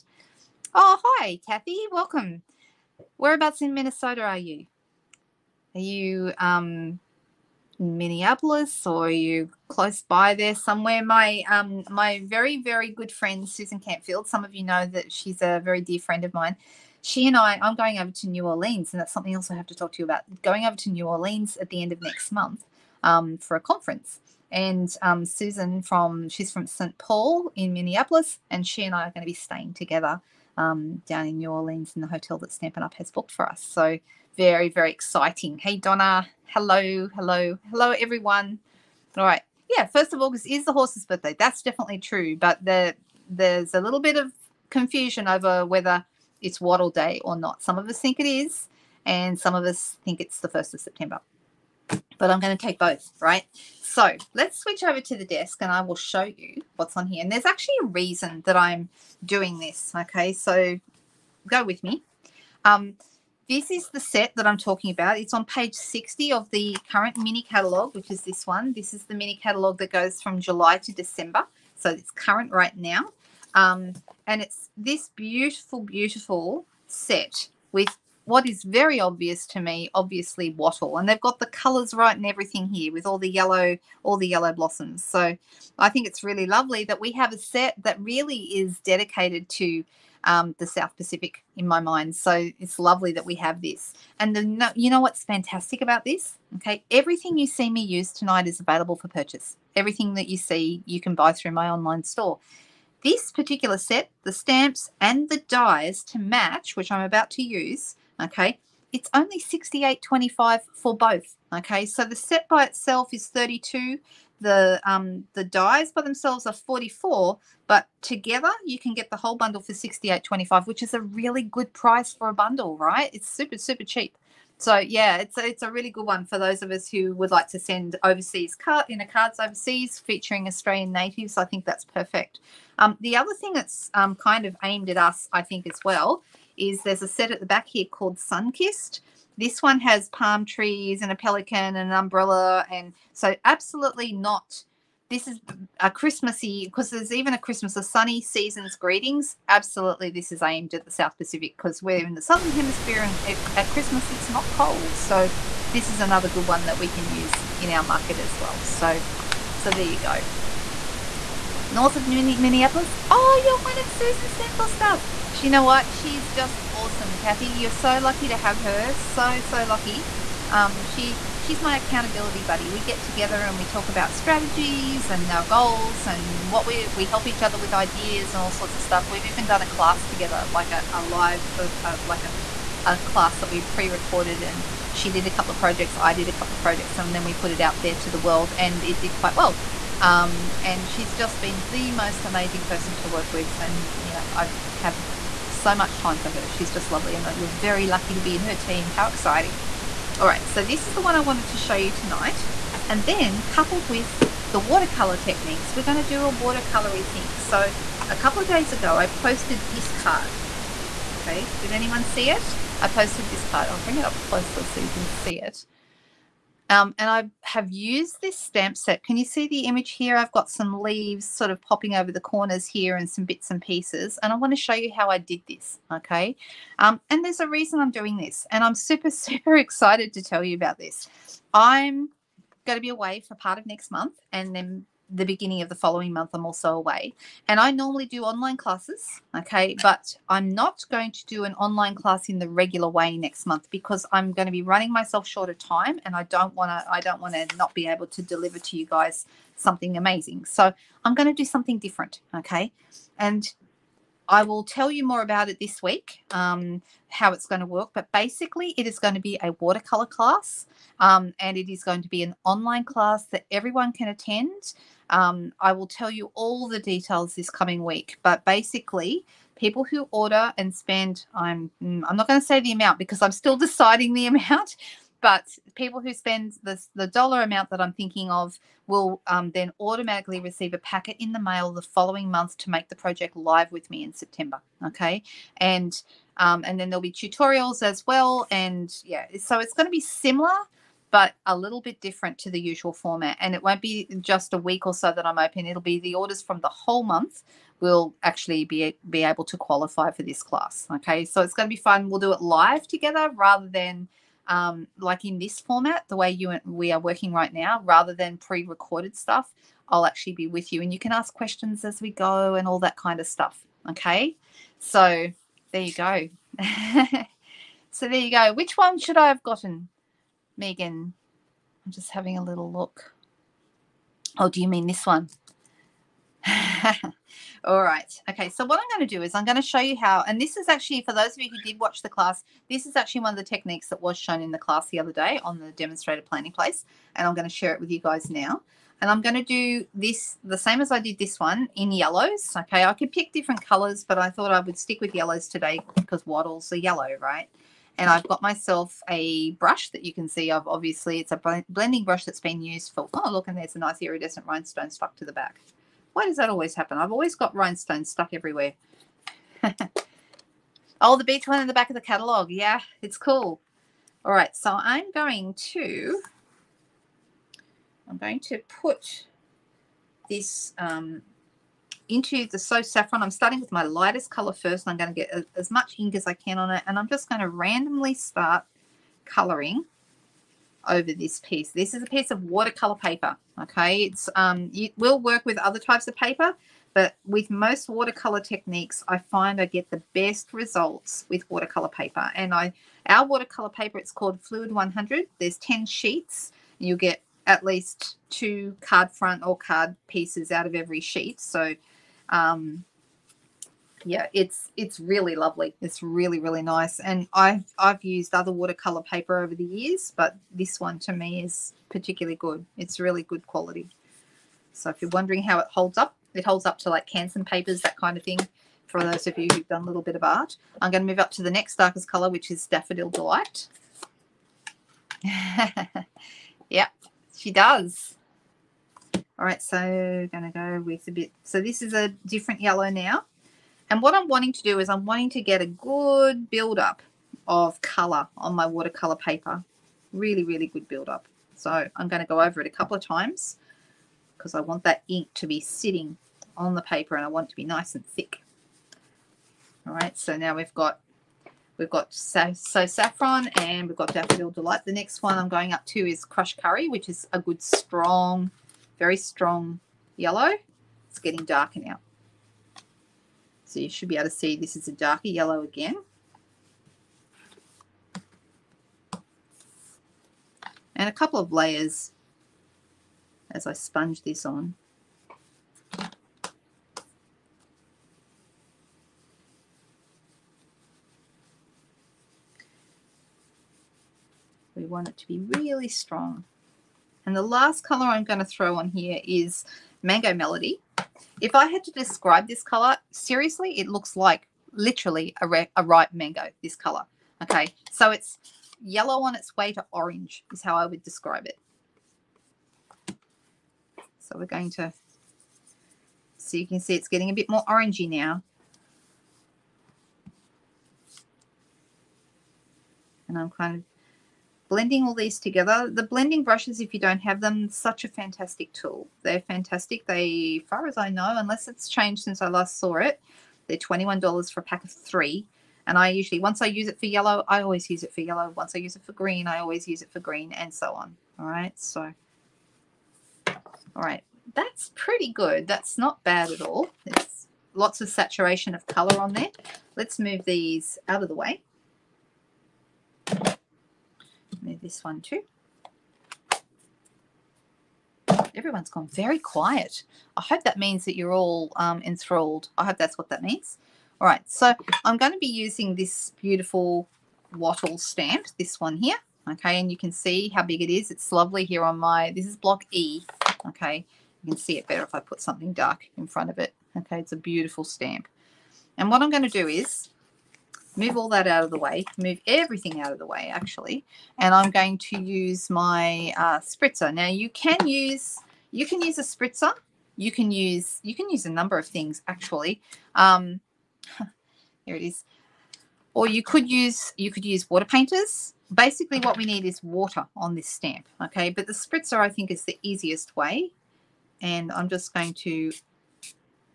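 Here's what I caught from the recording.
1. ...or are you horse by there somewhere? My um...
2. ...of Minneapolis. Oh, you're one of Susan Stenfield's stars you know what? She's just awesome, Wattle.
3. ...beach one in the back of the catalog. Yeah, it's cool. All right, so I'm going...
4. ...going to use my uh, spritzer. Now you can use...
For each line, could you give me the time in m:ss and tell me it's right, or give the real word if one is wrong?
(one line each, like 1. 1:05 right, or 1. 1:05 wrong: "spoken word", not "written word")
1. 0:08 wrong: "close", not "horse"
2. 2:41 wrong: "Kathy", not "Wattle"
3. 6:01 right
4. 9:34 right.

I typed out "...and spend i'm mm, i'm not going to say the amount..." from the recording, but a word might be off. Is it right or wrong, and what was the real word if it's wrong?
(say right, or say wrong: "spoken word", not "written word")
right.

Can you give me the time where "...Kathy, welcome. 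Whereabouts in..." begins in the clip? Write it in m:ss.
0:01.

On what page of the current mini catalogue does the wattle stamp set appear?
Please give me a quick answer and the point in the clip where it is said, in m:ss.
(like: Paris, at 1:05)
60, at 1:05.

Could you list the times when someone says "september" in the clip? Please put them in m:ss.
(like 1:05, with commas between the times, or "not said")
0:50, 4:44.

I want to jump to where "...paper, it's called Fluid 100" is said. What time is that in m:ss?
6:33.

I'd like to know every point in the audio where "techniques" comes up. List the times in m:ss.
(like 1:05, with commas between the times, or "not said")
3:25, 5:33, 6:28.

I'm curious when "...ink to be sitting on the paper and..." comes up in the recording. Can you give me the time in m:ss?
7:25.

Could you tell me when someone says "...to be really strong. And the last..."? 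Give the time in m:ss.
8:05.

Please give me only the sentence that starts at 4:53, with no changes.
And it won't be just a week or so that I'm open.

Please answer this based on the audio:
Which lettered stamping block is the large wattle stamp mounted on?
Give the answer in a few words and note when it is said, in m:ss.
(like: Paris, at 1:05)
Block E, at 9:22.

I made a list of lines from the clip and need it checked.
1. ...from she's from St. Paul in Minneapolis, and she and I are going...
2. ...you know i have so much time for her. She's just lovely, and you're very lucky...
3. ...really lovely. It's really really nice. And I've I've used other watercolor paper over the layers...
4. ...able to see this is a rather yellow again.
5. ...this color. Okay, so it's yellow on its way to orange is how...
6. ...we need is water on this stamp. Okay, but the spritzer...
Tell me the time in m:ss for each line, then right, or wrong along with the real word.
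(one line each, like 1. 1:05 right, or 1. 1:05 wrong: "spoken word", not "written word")
1. 0:25 right
2. 3:13 right
3. 6:44 wrong: "years", not "layers"
4. 7:44 wrong: "darker", not "rather"
5. 8:16 right
6. 9:49 right.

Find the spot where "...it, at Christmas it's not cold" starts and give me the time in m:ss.
2:33.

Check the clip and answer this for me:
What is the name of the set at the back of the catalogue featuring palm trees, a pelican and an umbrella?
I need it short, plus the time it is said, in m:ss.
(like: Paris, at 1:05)
Sunkissed, at 2:18.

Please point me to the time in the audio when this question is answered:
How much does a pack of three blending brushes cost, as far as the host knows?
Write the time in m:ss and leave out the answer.
8:43.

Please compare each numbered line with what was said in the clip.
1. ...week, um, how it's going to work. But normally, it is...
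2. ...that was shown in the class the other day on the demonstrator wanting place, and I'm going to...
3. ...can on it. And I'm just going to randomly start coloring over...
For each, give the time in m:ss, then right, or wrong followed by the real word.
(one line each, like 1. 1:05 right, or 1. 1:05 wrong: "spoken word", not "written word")
1. 4:15 wrong: "basically", not "normally"
2. 5:33 wrong: "planning", not "wanting"
3. 6:16 right.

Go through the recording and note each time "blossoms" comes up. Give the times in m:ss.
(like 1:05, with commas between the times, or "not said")
1:24.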